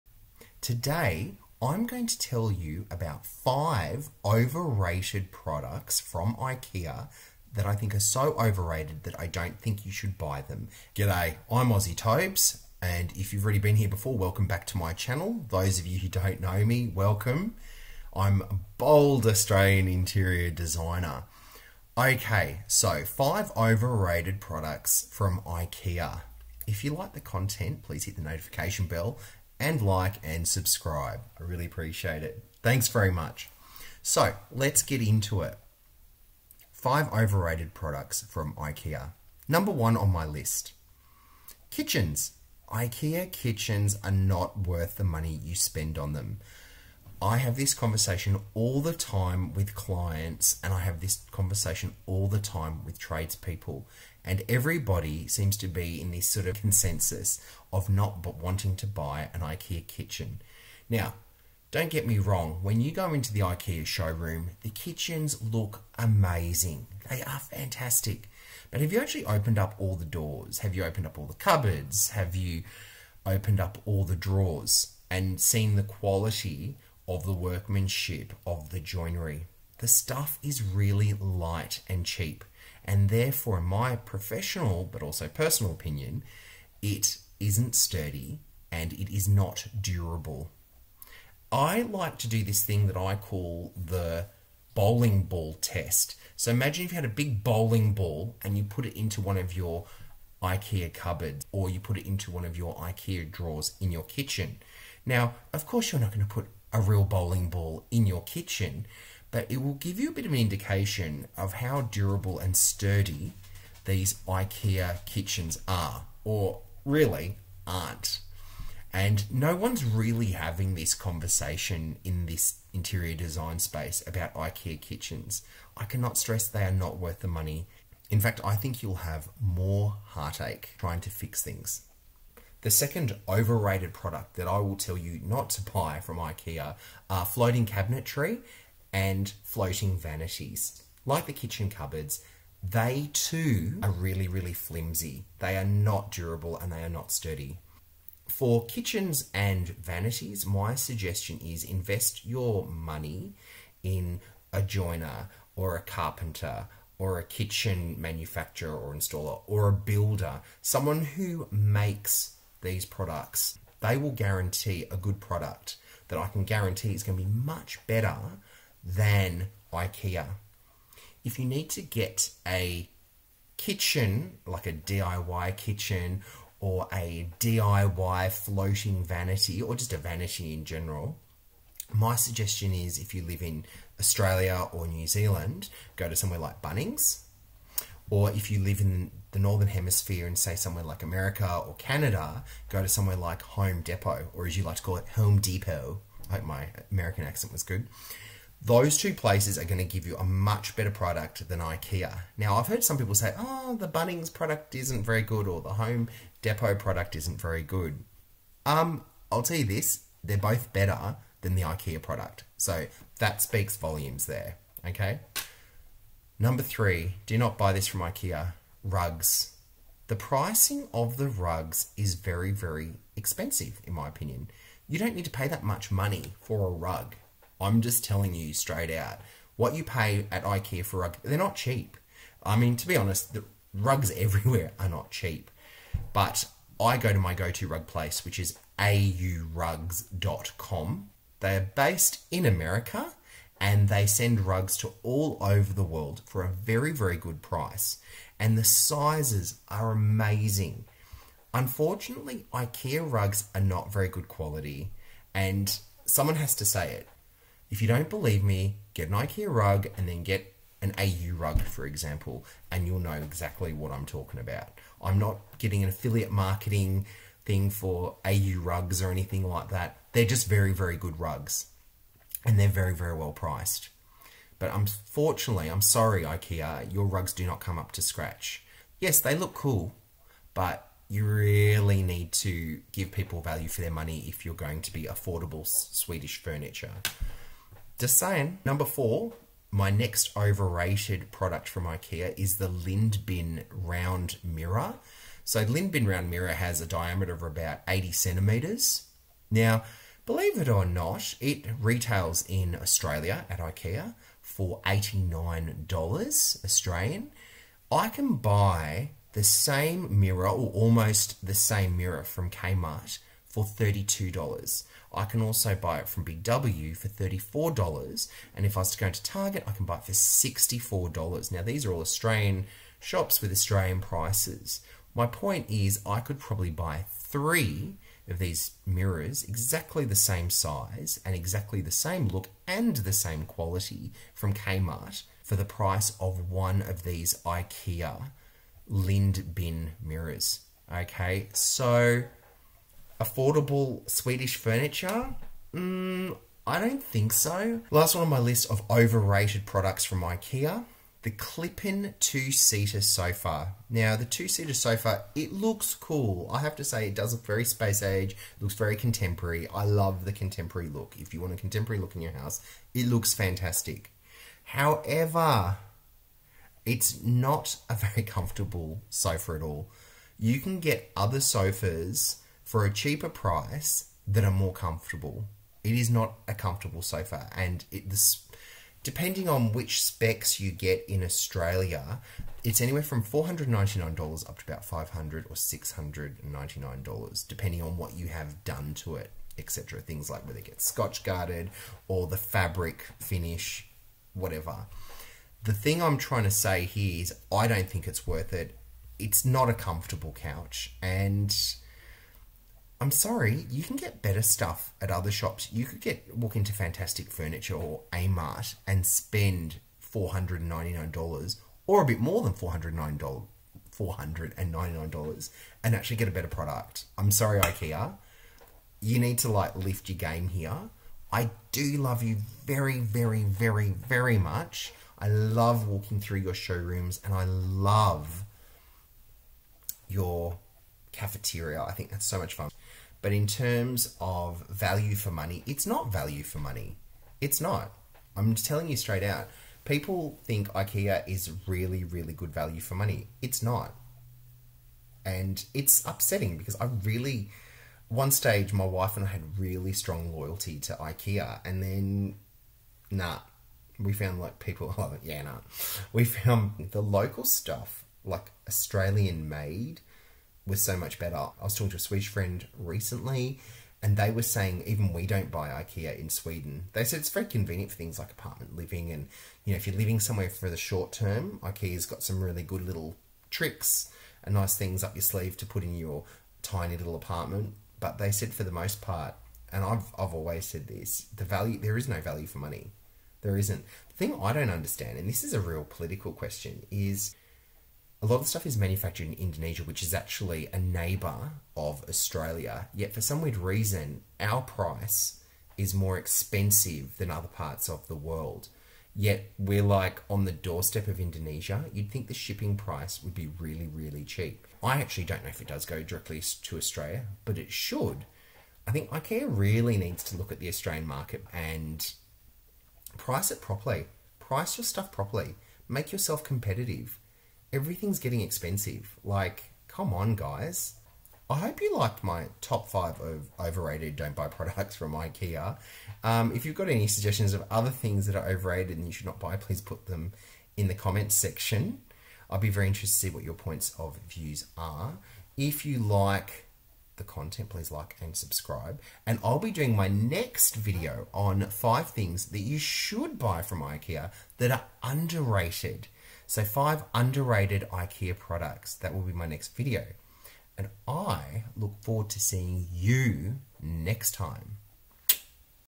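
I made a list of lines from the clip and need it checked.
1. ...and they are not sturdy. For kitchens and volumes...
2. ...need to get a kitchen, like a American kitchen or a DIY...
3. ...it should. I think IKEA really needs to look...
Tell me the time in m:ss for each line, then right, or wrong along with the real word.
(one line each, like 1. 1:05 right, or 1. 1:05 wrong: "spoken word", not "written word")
1. 2:26 wrong: "vanities", not "volumes"
2. 2:51 wrong: "DIY", not "American"
3. 8:27 right.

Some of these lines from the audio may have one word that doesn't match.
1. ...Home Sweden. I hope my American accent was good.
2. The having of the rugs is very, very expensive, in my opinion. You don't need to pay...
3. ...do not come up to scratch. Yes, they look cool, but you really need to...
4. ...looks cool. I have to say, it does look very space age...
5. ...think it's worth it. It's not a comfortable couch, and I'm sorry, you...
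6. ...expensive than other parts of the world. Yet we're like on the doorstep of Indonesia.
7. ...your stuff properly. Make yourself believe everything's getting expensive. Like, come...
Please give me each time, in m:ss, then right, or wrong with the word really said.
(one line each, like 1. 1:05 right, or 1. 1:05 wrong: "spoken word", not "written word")
1. 3:15 wrong: "Depot", not "Sweden"
2. 3:40 wrong: "pricing", not "having"
3. 4:37 right
4. 5:55 right
5. 6:37 right
6. 8:16 right
7. 8:34 wrong: "competitive", not "believe".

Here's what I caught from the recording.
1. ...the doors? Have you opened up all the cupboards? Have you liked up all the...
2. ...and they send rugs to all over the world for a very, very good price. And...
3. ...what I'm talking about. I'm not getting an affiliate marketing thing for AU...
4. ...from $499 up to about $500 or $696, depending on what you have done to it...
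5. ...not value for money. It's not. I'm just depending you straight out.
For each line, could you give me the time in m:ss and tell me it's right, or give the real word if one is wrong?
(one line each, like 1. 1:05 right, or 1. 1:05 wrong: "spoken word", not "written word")
1. 1:09 wrong: "opened", not "liked"
2. 4:03 right
3. 4:23 right
4. 6:23 wrong: "699", not "696"
5. 7:15 wrong: "telling", not "depending".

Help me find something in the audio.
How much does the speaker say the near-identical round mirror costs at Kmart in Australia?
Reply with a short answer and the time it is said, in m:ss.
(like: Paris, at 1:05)
$32, at 5:13.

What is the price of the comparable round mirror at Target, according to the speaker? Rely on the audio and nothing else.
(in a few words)
$64.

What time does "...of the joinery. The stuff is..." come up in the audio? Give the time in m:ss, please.
1:18.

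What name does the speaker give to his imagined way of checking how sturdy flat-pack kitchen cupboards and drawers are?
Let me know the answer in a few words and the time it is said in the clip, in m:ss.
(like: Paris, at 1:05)
bowling ball test, at 1:34.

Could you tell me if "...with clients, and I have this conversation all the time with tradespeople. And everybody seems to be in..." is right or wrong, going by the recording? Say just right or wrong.
right.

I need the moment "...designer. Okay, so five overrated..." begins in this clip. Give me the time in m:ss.
0:20.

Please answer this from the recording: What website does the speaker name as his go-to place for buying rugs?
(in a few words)
aurugs.com.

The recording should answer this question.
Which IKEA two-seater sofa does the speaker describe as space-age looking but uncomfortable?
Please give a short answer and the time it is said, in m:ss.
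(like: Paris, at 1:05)
Klippan, at 5:51.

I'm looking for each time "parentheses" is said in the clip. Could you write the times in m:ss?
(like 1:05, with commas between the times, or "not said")
not said.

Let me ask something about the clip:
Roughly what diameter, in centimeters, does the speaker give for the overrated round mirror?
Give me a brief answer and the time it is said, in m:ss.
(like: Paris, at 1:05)
80 centimeters, at 4:57.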